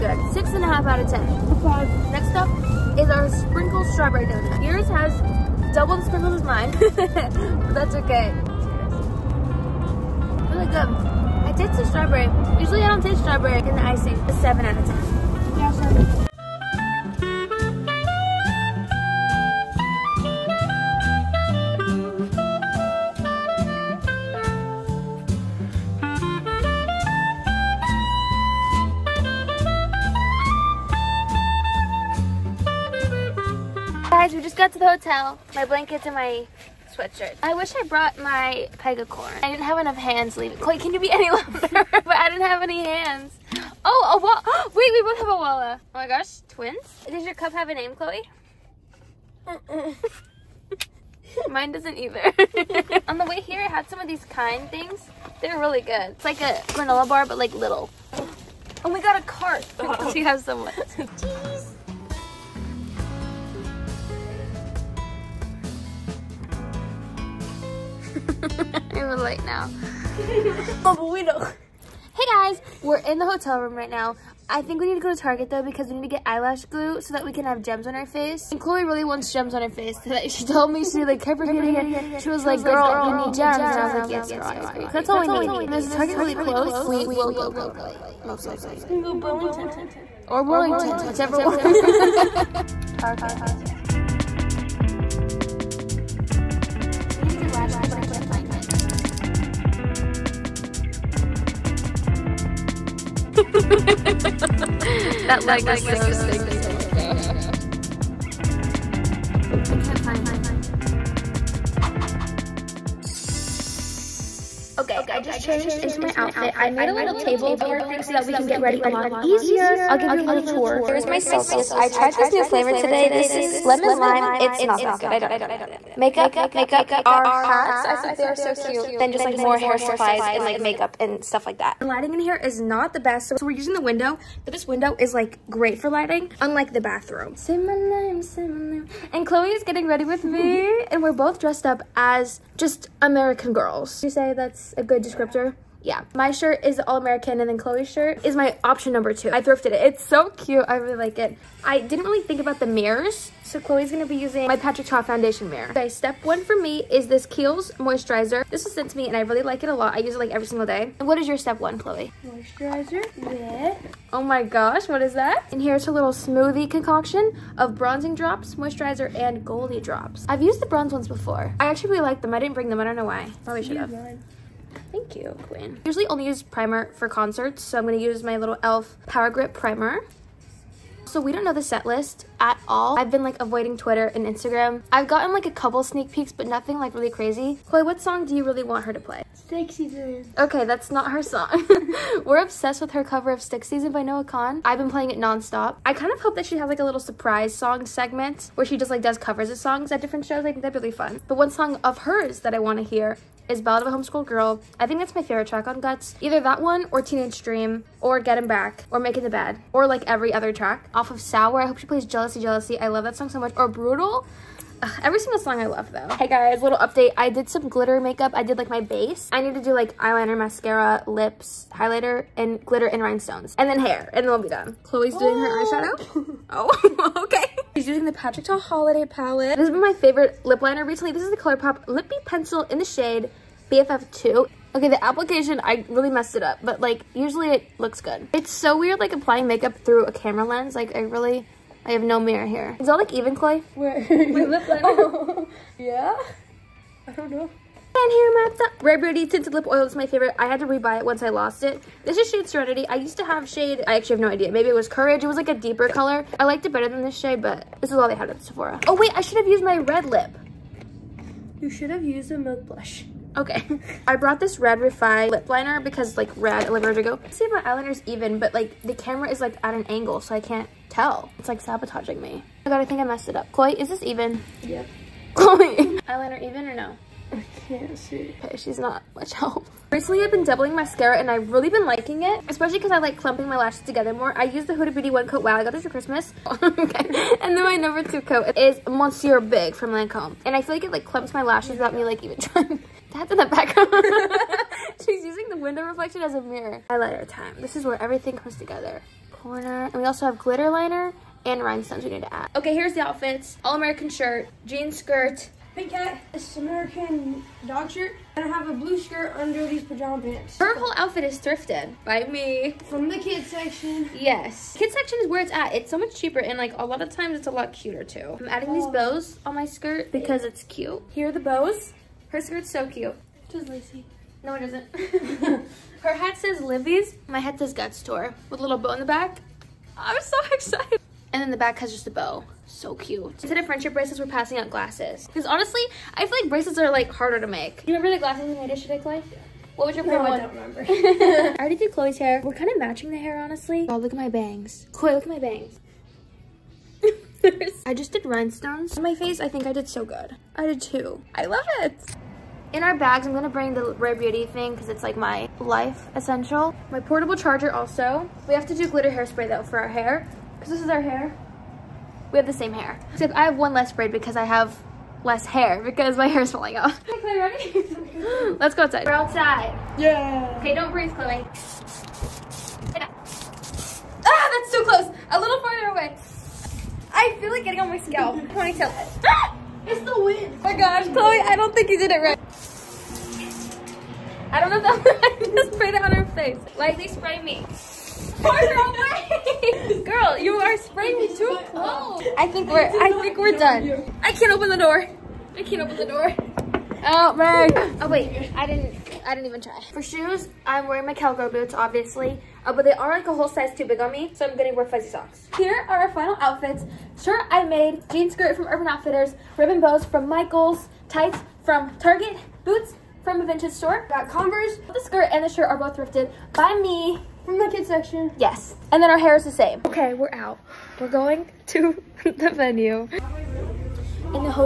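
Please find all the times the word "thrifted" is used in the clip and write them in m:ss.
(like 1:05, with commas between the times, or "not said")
2:29, 5:11, 6:55.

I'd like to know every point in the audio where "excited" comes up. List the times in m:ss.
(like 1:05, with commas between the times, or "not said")
5:30.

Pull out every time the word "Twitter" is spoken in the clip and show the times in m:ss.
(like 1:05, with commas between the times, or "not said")
3:03.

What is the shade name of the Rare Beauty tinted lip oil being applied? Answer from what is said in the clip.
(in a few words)
Serenity.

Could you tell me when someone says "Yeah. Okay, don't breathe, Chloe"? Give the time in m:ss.
6:09.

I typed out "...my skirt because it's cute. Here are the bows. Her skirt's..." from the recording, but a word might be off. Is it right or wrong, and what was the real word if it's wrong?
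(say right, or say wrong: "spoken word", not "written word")
right.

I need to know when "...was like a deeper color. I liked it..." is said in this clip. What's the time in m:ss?
4:15.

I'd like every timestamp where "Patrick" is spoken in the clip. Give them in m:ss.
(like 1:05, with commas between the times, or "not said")
2:34, 3:48.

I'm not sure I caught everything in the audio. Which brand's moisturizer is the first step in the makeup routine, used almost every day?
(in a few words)
Kiehl's.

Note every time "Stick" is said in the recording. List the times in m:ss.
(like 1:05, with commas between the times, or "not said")
3:09, 3:13.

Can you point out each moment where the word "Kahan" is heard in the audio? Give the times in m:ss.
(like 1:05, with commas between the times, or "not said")
3:14.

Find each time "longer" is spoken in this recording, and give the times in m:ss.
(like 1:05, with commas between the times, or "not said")
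0:41.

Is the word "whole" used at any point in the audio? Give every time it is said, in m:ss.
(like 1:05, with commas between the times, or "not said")
5:10, 6:43.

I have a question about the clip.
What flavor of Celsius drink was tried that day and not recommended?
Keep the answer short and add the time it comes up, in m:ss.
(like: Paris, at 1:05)
Lemon lime, at 2:03.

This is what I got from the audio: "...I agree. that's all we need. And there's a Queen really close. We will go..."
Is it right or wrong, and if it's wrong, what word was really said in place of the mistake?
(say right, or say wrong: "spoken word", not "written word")
wrong: "Target", not "Queen".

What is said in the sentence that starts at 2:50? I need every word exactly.
I've used the bronze ones before.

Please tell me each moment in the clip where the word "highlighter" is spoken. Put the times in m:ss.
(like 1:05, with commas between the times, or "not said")
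3:41, 4:56.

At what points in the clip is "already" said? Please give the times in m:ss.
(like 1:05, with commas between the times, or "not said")
5:41.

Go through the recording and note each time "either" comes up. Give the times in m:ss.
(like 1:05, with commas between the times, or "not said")
0:51, 3:26.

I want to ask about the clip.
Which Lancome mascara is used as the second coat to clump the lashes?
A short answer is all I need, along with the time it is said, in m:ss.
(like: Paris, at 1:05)
Monsieur Big, at 4:48.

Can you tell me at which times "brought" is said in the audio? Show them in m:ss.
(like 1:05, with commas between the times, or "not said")
0:37, 4:24.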